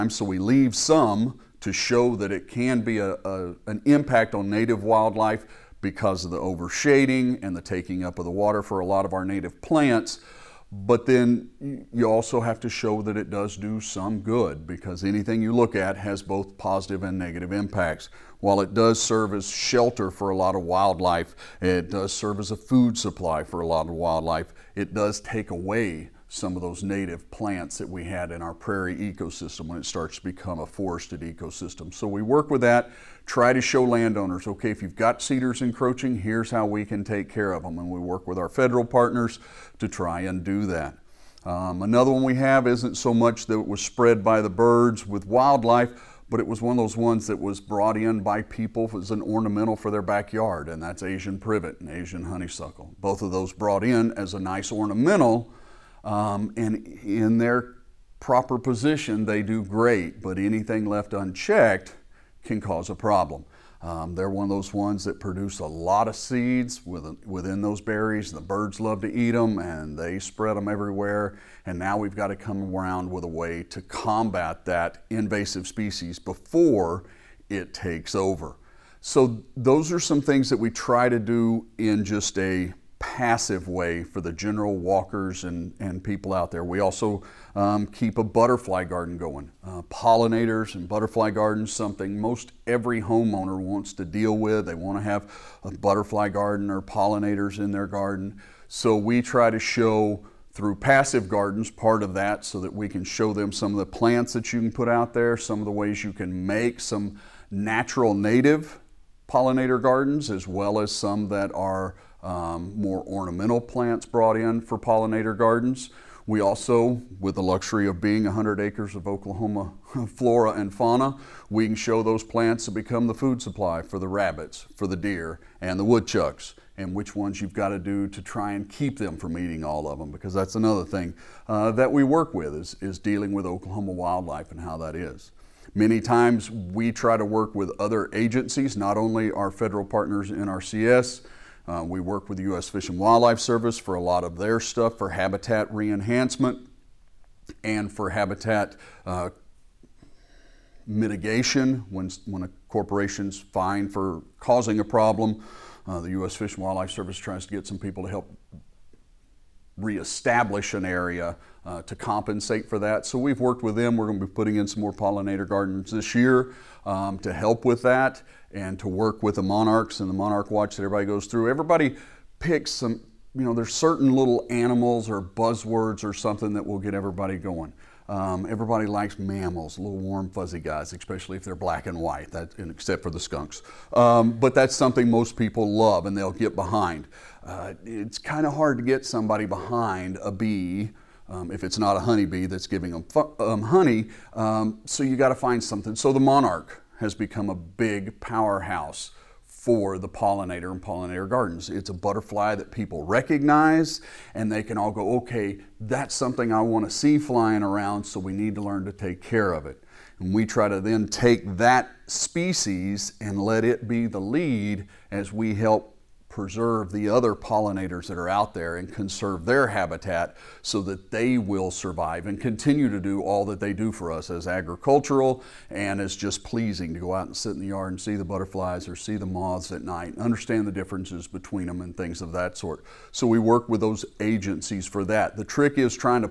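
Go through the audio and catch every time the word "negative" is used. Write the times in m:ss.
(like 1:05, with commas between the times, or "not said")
0:17.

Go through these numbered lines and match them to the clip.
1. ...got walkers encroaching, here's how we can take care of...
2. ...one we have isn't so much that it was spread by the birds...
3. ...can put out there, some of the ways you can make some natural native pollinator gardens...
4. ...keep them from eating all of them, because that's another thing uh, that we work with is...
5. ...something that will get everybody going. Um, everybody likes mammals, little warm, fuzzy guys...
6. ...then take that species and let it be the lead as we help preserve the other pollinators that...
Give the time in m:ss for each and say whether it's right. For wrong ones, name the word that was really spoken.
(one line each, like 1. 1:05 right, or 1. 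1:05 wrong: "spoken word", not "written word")
1. 0:34 wrong: "cedars", not "walkers"
2. 0:42 right
3. 1:44 right
4. 2:08 right
5. 2:56 right
6. 3:30 right.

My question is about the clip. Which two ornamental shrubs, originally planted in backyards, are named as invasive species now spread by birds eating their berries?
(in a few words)
Asian privet and Asian honeysuckle.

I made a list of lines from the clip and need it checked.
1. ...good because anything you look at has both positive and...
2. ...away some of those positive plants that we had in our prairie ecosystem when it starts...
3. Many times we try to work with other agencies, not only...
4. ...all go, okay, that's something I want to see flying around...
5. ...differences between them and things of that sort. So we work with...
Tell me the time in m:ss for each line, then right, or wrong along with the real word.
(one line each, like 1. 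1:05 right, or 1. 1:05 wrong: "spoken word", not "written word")
1. 0:14 right
2. 0:25 wrong: "native", not "positive"
3. 2:15 right
4. 3:24 right
5. 3:50 right.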